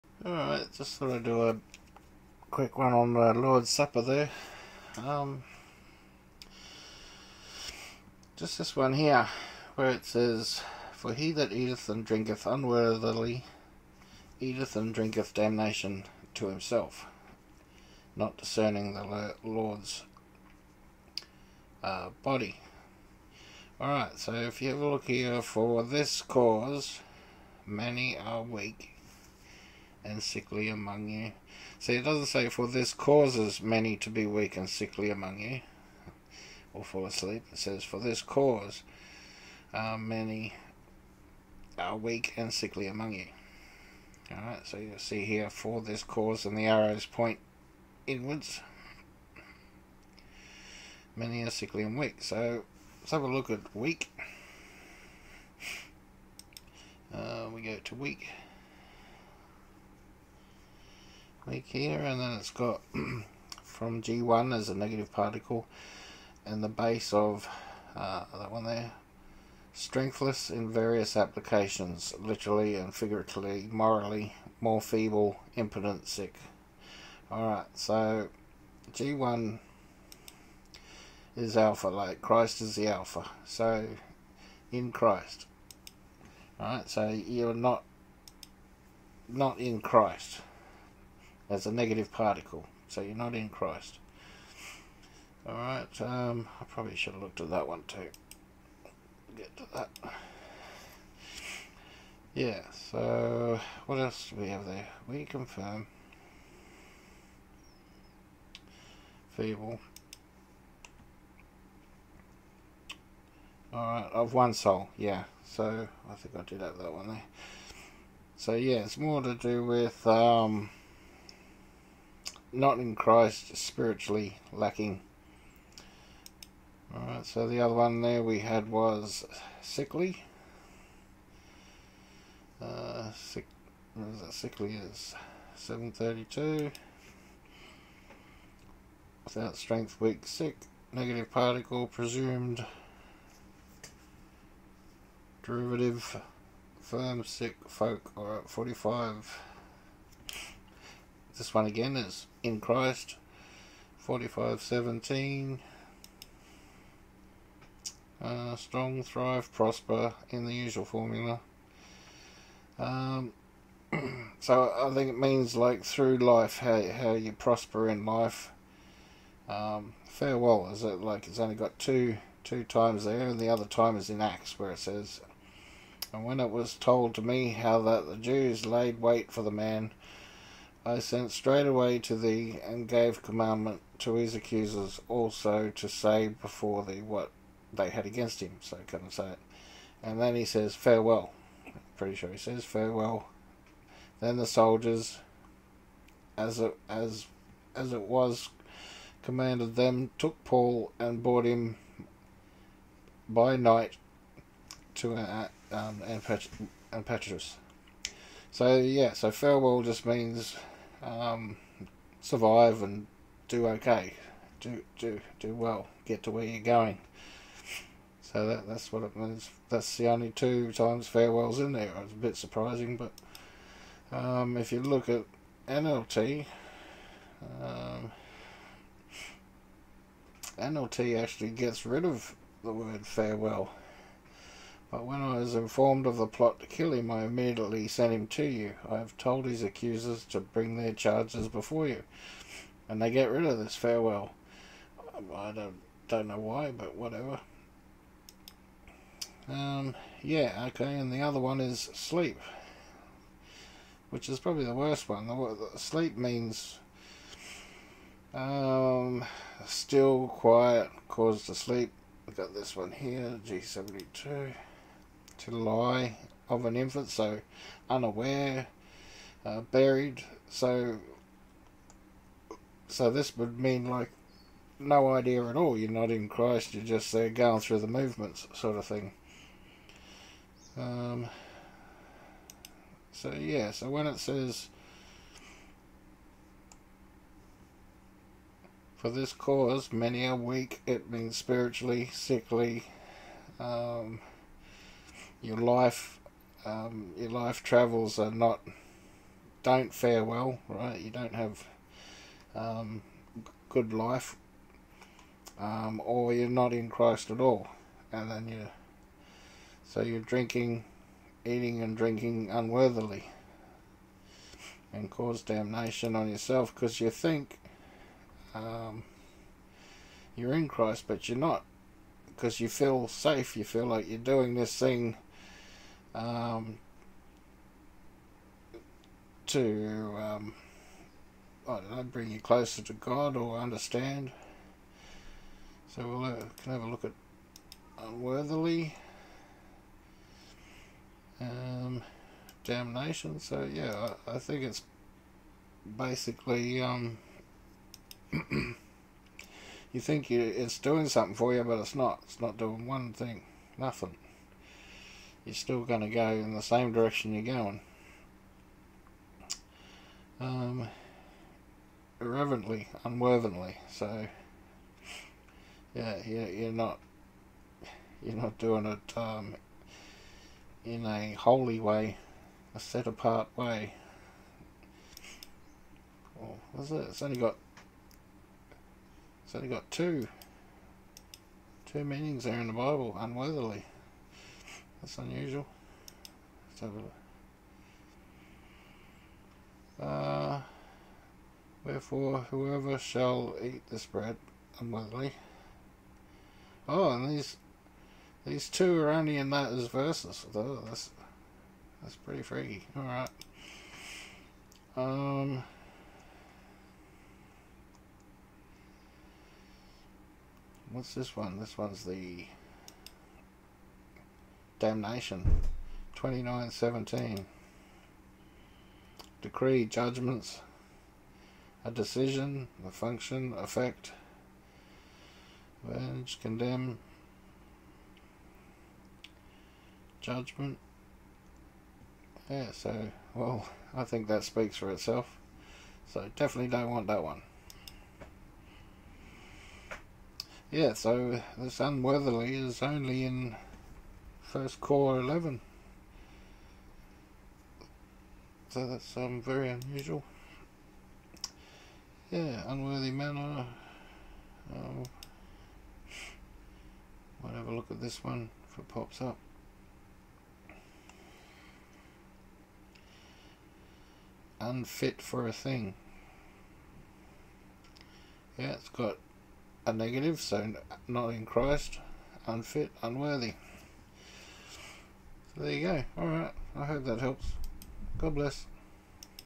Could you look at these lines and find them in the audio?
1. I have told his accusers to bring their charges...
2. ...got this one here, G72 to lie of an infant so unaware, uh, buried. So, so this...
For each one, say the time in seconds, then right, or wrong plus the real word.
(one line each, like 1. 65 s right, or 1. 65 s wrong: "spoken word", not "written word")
1. 238 s right
2. 262 s right.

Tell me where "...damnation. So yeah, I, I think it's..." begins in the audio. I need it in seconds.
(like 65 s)
342 s.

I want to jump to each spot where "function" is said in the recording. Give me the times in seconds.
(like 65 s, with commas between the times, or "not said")
422 s.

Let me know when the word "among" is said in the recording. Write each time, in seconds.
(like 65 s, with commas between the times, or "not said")
30 s, 35 s, 42 s.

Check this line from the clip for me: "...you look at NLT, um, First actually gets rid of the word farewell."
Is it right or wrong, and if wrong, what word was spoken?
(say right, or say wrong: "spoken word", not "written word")
wrong: "NLT", not "First".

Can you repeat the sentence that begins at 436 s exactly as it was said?
So definitely don't want that one.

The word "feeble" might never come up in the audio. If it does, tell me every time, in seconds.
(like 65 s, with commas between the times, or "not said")
74 s, 109 s.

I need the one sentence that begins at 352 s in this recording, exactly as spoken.
It's not doing one thing, nothing you're still going to go in the same direction you're going.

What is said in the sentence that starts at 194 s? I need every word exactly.
Then the soldiers, as it, as, as it was commanded them, took Paul and brought him by night to uh, um, Antipatris.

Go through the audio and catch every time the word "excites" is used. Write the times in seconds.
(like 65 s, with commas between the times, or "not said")
not said.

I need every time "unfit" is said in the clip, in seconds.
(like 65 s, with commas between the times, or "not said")
464 s, 472 s.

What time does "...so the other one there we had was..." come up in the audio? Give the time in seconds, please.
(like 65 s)
127 s.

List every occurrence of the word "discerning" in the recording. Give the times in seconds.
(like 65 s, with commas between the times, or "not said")
18 s.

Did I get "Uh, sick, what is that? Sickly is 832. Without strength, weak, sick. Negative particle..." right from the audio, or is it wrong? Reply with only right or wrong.
wrong.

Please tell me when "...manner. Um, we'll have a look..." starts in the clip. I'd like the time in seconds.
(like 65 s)
453 s.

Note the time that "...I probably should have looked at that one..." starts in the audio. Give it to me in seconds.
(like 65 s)
96 s.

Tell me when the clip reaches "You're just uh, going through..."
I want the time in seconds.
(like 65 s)
276 s.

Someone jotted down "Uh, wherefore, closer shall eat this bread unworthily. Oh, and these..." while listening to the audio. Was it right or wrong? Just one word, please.
wrong.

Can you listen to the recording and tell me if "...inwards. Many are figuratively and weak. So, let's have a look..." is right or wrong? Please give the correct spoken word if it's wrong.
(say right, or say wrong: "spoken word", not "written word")
wrong: "sickly", not "figuratively".